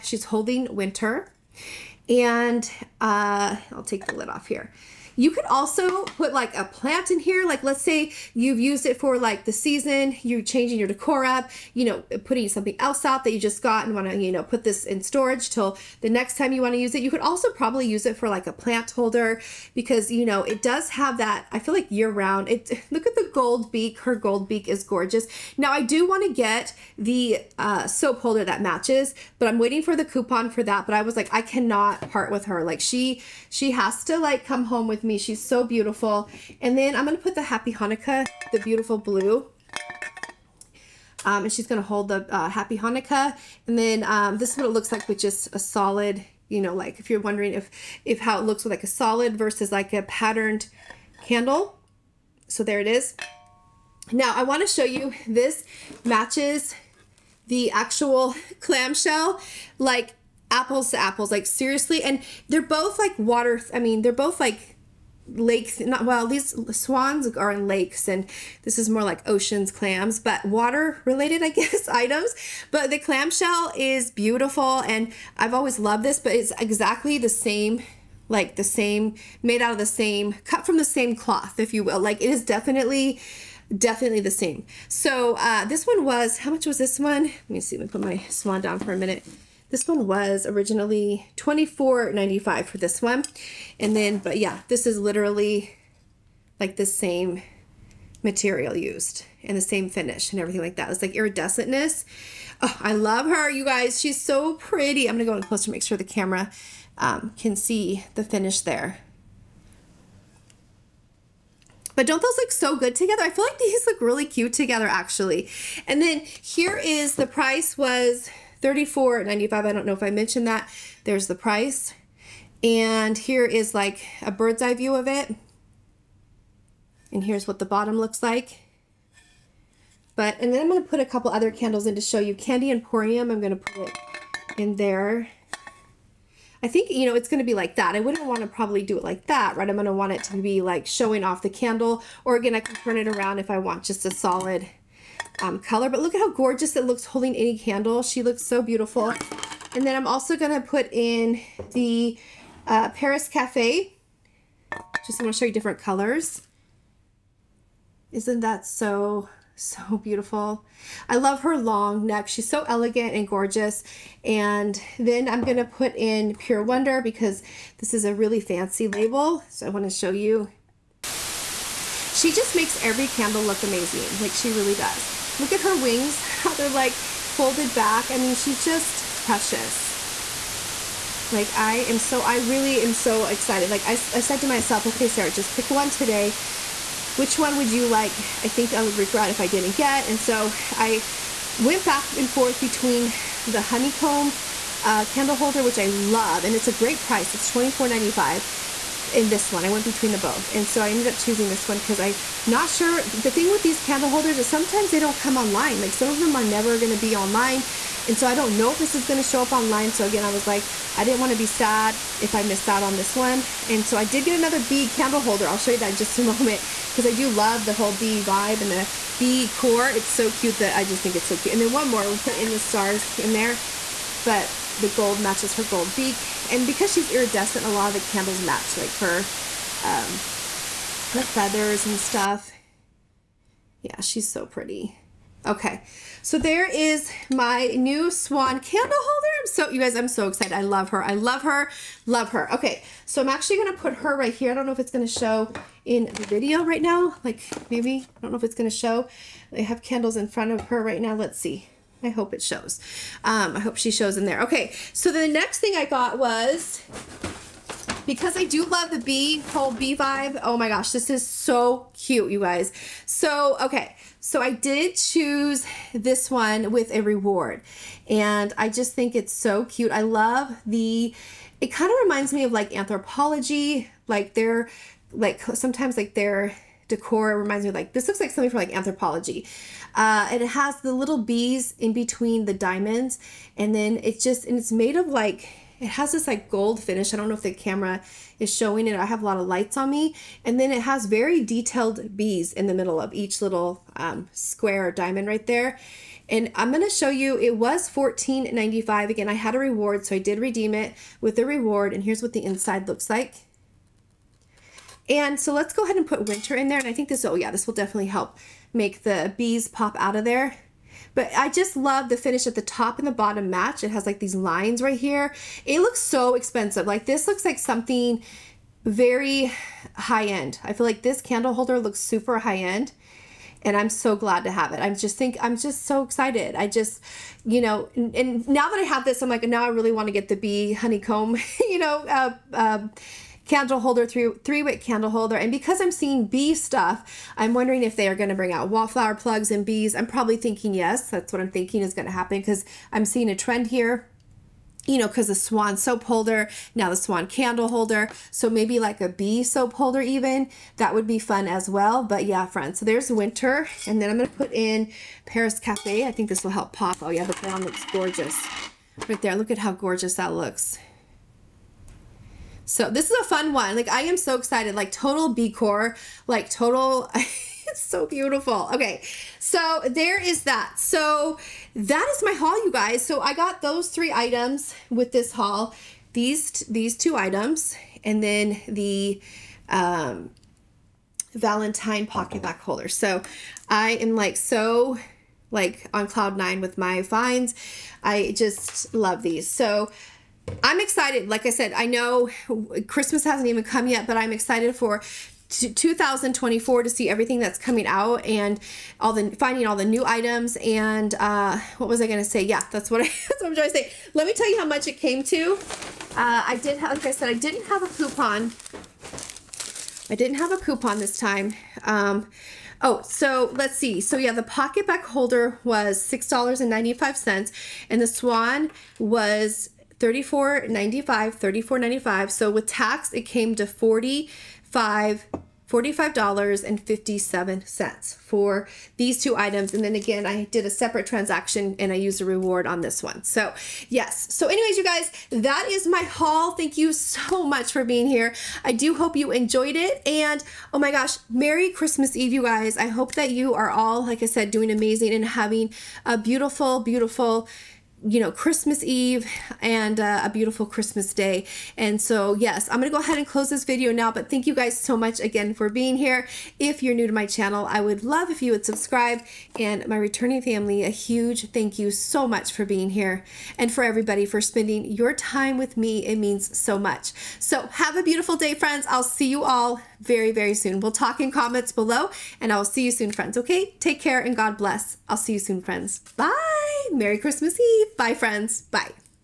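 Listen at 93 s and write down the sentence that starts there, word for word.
And then, but yeah, this is literally like the same material used and the same finish and everything like that.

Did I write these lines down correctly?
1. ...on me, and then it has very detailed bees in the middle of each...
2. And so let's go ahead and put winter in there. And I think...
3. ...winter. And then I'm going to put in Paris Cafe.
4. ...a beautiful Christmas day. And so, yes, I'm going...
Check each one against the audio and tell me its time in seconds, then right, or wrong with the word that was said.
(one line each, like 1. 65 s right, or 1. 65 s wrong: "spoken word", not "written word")
1. 289 s right
2. 305 s right
3. 353 s right
4. 450 s right.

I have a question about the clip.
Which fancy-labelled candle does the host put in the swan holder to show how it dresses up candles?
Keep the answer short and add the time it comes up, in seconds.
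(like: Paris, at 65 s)
Pure Wonder, at 166 s.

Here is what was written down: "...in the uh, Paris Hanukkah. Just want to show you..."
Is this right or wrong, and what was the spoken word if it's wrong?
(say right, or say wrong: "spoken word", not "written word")
wrong: "Cafe", not "Hanukkah".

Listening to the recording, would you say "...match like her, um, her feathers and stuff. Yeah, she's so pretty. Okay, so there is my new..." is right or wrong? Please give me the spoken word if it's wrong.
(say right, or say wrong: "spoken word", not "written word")
right.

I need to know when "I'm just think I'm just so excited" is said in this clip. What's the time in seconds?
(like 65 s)
324 s.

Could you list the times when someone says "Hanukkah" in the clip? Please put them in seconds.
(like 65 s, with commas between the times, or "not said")
37 s, 42 s.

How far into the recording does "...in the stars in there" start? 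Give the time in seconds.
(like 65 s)
222 s.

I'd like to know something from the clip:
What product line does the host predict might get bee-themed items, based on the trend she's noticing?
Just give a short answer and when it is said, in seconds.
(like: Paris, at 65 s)
wallflower plugs, at 338 s.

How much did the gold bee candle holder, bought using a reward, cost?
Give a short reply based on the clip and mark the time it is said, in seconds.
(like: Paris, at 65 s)
$14.95, at 297 s.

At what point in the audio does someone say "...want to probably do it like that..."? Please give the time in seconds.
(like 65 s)
138 s.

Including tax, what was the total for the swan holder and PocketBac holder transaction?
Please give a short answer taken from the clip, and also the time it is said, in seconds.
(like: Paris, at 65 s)
$45.57, at 425 s.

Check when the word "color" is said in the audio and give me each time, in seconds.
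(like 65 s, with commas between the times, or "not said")
145 s, 155 s.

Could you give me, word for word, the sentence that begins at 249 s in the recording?
I have candles in front of her right now.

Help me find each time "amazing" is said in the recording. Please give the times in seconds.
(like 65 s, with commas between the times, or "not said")
173 s, 444 s.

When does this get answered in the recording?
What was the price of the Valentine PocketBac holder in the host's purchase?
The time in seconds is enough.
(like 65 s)
416 s.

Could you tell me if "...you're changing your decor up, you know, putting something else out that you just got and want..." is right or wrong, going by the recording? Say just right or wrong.
right.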